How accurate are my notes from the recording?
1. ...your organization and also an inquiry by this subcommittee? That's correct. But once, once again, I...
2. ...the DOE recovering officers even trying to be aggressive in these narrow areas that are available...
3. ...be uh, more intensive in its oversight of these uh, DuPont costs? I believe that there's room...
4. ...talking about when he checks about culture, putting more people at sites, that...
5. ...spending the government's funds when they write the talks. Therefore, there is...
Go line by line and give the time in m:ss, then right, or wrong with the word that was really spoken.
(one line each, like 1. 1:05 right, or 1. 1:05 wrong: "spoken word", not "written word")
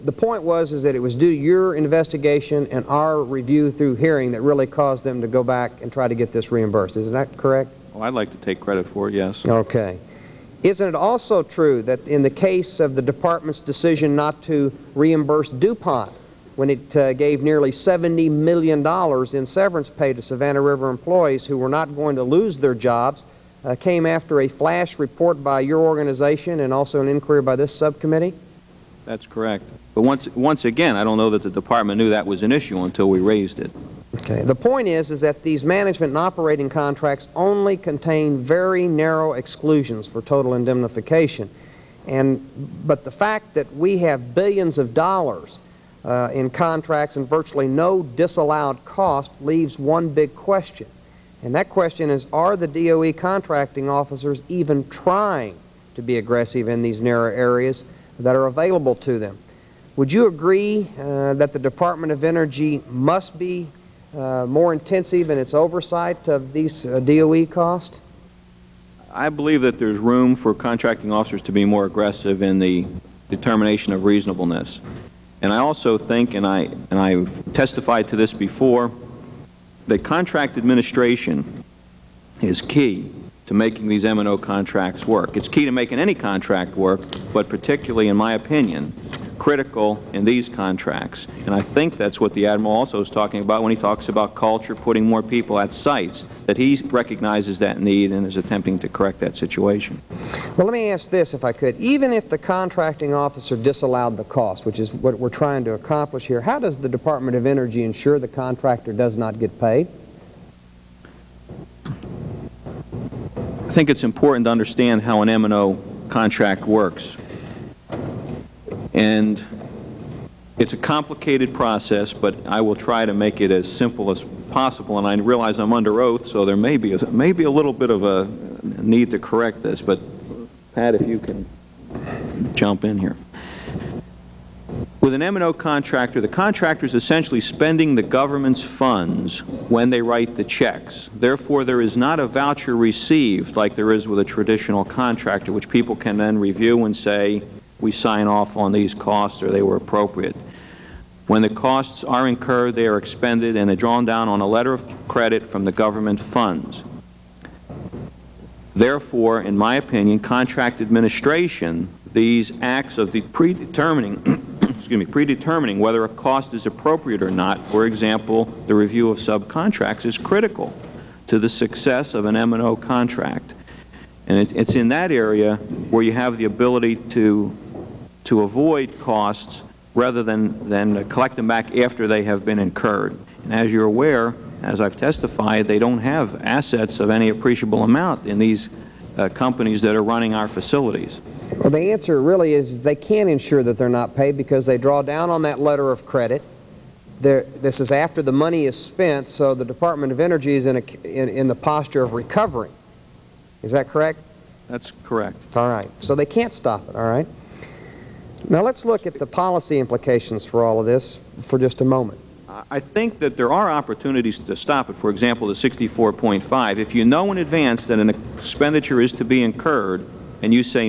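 1. 0:25 right
2. 0:52 wrong: "contracting", not "recovering"
3. 1:03 wrong: "DOE", not "DuPont"
4. 1:33 wrong: "talks", not "checks"
5. 2:17 wrong: "checks", not "talks".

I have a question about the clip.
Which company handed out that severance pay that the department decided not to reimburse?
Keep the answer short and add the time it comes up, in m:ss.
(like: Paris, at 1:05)
DuPont, at 0:15.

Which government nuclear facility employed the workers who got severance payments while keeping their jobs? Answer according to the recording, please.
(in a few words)
Savannah River.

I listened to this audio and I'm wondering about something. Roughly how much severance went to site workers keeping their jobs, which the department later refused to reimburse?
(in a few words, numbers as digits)
$70 million.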